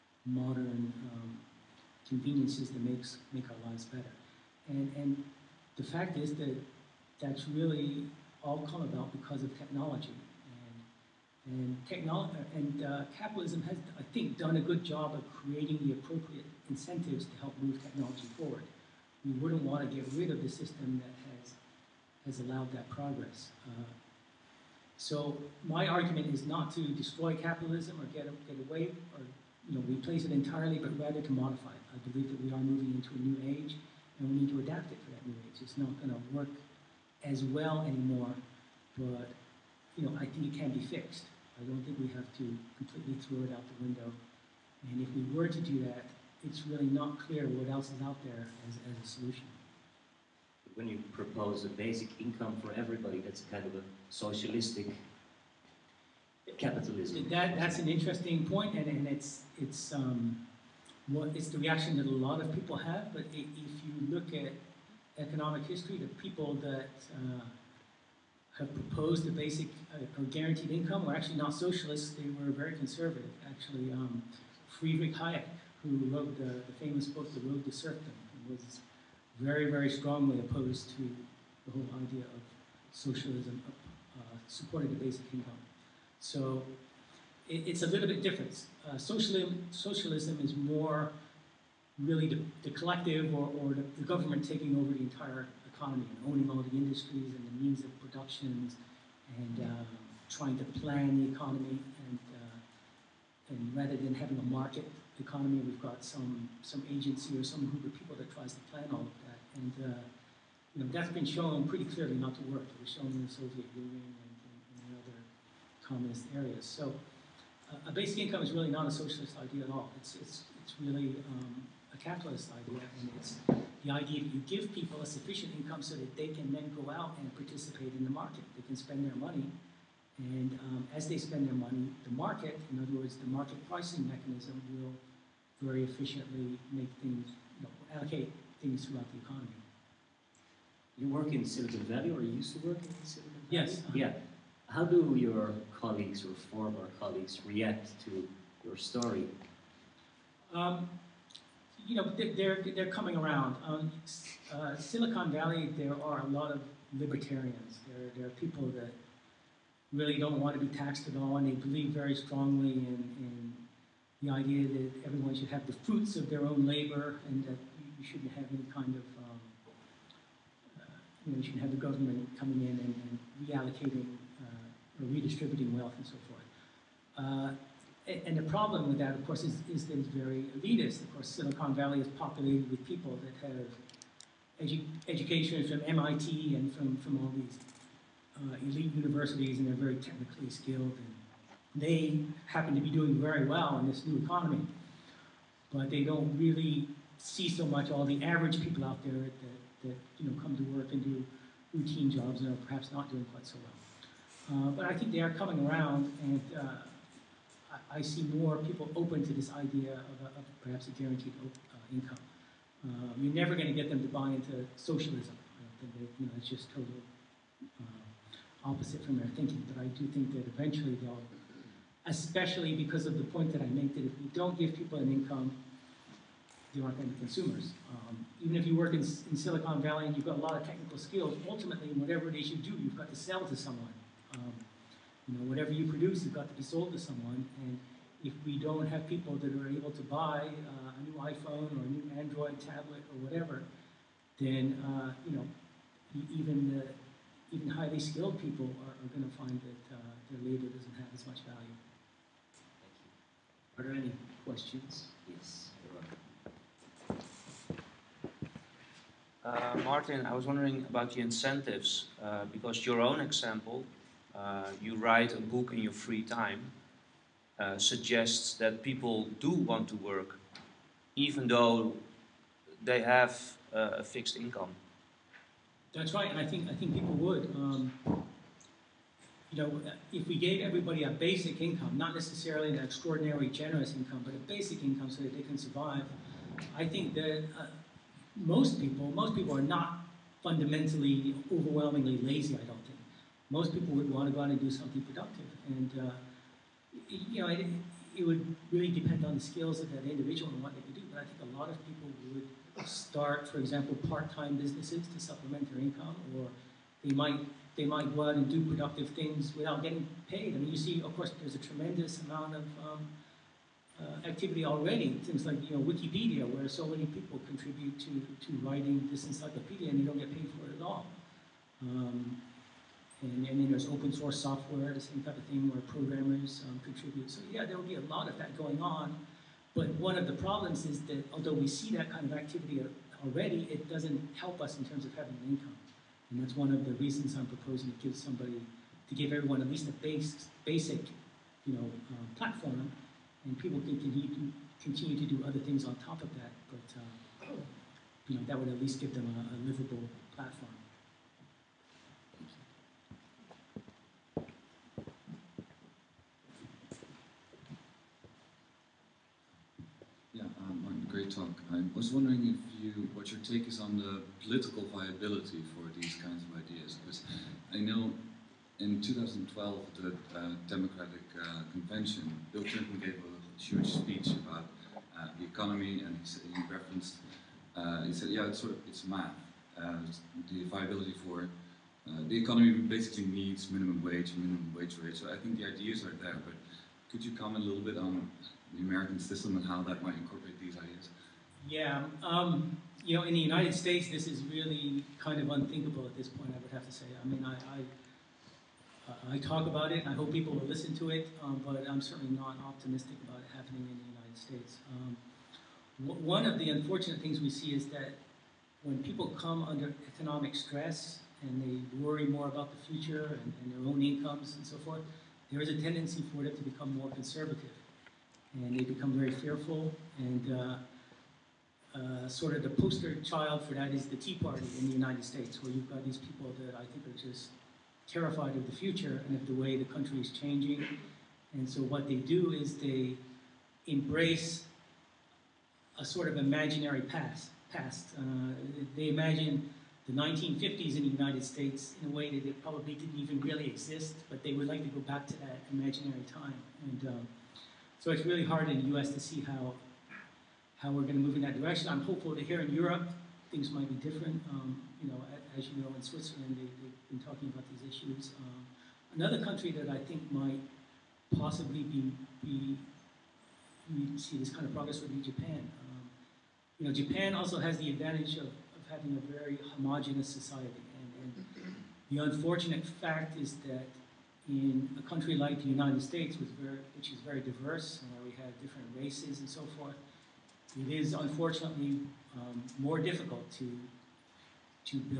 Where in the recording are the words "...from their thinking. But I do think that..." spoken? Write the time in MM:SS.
03:39.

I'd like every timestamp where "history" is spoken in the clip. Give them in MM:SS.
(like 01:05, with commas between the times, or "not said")
01:05.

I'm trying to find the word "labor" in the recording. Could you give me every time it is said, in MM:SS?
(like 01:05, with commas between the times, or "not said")
02:46, 04:10.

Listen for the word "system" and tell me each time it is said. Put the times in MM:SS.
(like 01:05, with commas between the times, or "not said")
00:20, 06:29.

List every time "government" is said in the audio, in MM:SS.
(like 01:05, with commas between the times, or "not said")
01:34, 02:51.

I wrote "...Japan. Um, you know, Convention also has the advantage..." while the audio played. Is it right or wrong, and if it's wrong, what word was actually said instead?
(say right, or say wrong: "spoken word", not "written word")
wrong: "Japan", not "Convention".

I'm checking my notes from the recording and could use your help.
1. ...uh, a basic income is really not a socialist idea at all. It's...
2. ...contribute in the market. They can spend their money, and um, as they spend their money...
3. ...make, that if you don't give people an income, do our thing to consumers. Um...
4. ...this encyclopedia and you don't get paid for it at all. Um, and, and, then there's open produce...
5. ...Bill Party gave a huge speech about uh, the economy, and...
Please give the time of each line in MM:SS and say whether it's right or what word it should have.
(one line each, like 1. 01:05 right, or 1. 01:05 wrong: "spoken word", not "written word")
1. 01:57 right
2. 02:07 wrong: "participate", not "contribute"
3. 03:43 right
4. 05:19 wrong: "source", not "produce"
5. 06:12 wrong: "Clinton", not "Party".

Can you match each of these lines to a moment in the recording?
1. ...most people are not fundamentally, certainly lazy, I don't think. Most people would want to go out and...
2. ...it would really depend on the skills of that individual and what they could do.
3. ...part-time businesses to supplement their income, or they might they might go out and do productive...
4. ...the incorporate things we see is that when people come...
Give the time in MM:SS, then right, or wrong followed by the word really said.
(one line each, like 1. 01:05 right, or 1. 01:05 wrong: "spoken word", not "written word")
1. 04:49 wrong: "overwhelmingly", not "certainly"
2. 04:58 right
3. 05:04 right
4. 06:46 wrong: "unfortunate", not "incorporate".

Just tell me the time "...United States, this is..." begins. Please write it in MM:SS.
06:33.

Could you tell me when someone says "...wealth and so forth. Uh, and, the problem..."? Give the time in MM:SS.
02:55.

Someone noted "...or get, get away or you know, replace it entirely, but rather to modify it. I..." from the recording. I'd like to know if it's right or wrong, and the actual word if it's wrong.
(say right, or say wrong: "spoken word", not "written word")
right.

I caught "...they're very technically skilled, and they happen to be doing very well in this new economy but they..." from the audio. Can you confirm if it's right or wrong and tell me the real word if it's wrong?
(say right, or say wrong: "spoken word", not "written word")
right.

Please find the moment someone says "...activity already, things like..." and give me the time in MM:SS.
05:14.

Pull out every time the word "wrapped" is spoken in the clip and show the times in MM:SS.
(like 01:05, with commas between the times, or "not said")
not said.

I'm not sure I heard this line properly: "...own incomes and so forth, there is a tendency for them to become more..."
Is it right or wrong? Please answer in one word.
right.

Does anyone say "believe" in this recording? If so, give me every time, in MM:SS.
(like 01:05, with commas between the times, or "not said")
00:32, 02:41.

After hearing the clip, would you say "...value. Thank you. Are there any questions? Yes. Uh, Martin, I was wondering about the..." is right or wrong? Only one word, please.
right.